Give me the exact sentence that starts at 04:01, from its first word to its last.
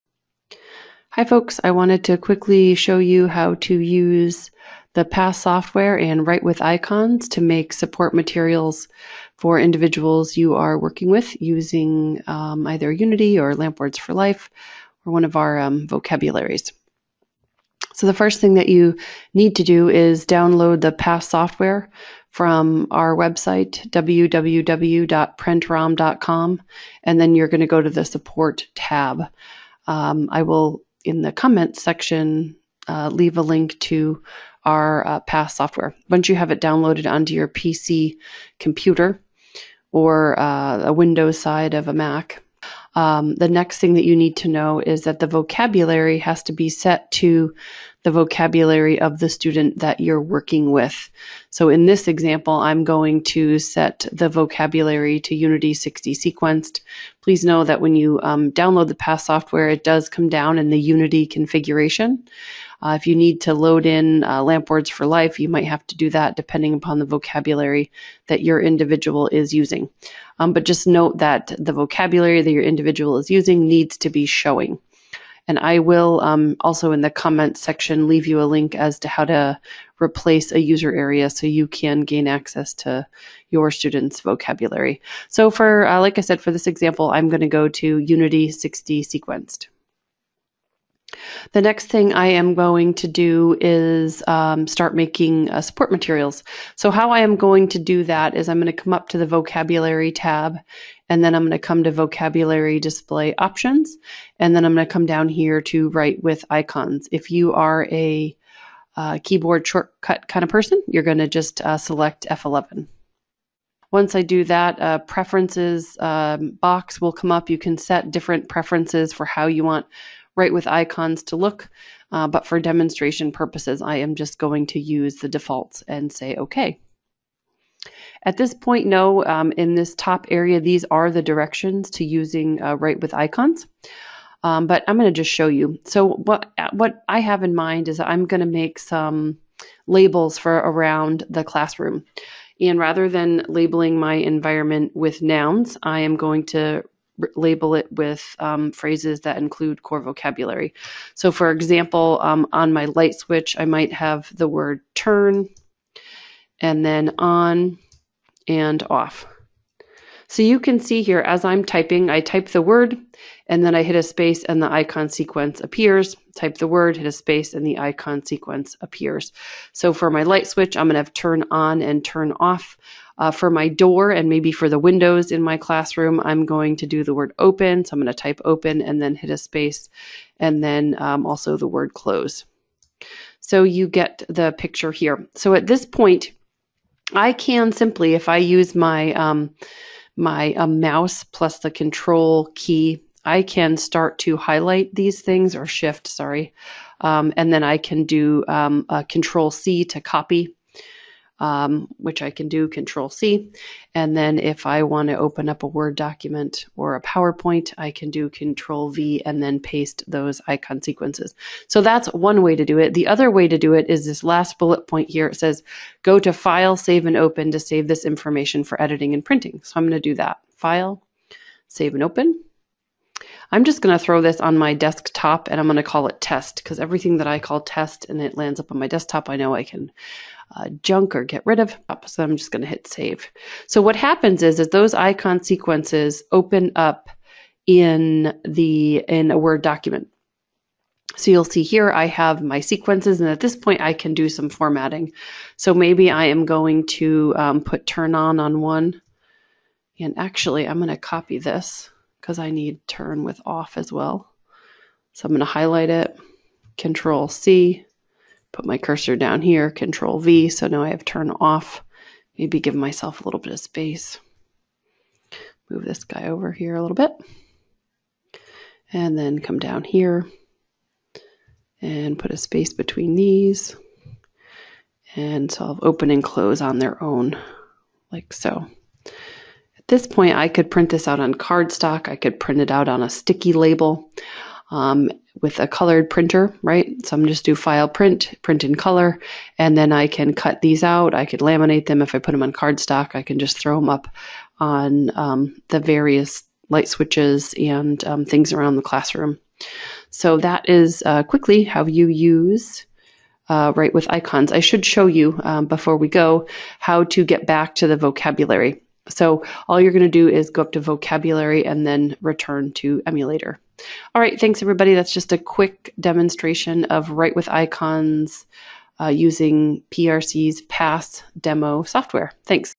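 So you'll see here I have my sequences and at this point I can do some formatting.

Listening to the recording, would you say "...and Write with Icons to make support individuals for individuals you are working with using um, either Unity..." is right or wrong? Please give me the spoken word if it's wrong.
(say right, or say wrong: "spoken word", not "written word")
wrong: "materials", not "individuals".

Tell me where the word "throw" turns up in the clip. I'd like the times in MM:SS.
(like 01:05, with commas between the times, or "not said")
03:44, 04:53.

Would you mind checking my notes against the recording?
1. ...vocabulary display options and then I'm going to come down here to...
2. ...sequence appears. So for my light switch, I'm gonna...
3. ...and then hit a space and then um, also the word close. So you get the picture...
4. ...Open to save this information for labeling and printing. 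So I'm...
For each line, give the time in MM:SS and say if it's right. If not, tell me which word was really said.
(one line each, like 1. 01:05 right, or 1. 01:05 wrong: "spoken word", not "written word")
1. 01:41 right
2. 02:48 right
3. 02:58 right
4. 03:37 wrong: "editing", not "labeling".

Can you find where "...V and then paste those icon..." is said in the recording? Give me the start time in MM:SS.
03:28.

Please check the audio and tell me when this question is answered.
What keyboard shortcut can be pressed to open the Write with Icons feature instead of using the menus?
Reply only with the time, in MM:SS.
01:52.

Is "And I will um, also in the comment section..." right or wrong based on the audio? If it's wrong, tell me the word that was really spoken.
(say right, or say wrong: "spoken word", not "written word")
right.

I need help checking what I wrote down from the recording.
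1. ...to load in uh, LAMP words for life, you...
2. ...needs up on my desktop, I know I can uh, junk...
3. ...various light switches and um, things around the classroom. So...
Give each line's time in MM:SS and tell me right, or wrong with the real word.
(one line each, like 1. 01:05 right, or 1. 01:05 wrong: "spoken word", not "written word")
1. 01:03 right
2. 03:48 wrong: "lands", not "needs"
3. 04:55 right.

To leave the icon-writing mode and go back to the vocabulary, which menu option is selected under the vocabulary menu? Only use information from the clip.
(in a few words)
return to emulator.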